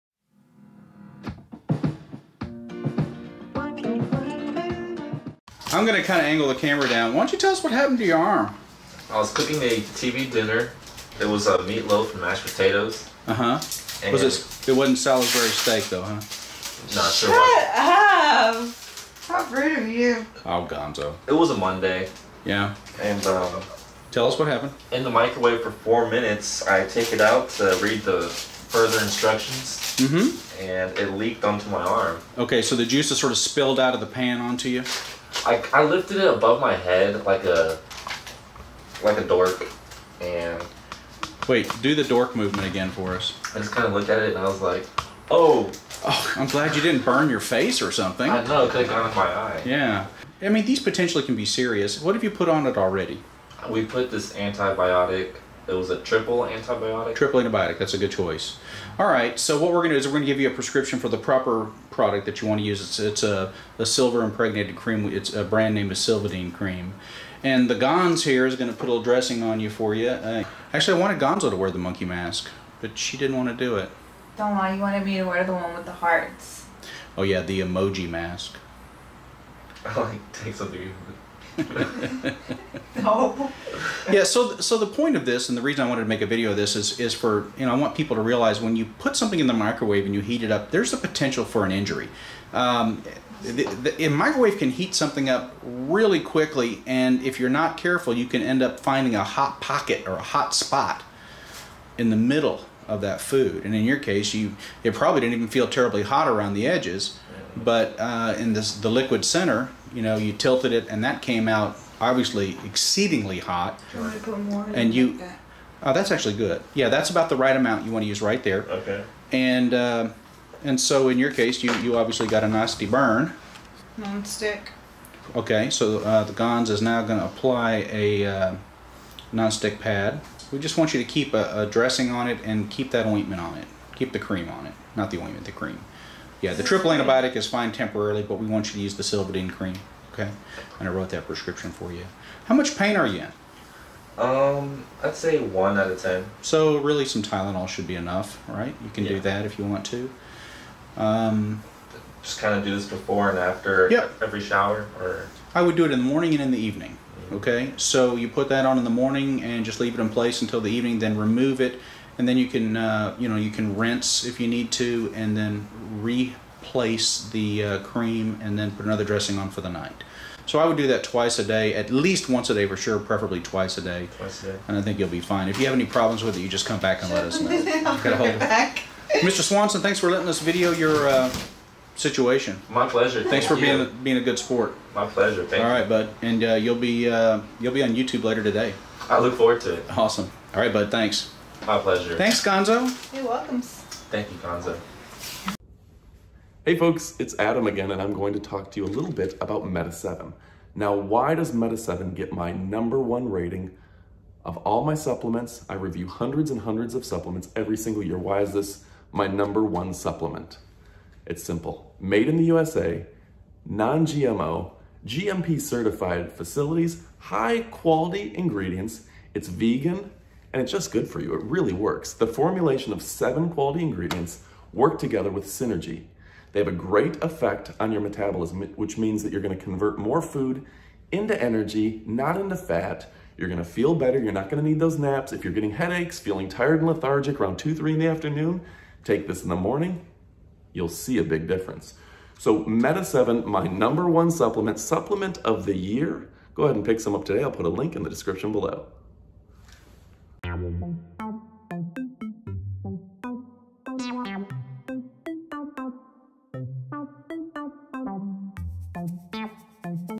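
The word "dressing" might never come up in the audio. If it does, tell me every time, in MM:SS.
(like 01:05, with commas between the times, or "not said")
01:09, 02:11, 02:49.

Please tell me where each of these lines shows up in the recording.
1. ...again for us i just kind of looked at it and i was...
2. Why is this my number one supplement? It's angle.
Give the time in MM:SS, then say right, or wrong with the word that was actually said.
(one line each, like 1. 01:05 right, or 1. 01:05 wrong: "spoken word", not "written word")
1. 00:42 right
2. 03:28 wrong: "simple", not "angle".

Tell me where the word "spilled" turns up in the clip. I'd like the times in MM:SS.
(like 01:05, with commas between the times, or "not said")
00:33.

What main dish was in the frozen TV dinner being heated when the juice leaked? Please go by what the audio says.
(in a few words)
Meatloaf.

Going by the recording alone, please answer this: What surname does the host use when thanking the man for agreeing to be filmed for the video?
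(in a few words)
Swanson.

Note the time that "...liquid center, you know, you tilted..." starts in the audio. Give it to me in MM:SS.
01:48.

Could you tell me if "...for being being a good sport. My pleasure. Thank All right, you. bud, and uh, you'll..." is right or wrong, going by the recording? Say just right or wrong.
right.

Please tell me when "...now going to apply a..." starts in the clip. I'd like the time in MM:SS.
02:06.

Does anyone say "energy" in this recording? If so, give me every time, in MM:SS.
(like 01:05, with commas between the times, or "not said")
03:51.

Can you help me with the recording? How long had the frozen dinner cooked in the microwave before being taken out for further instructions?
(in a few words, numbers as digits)
4 minutes.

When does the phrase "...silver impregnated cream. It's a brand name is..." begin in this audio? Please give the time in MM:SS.
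01:03.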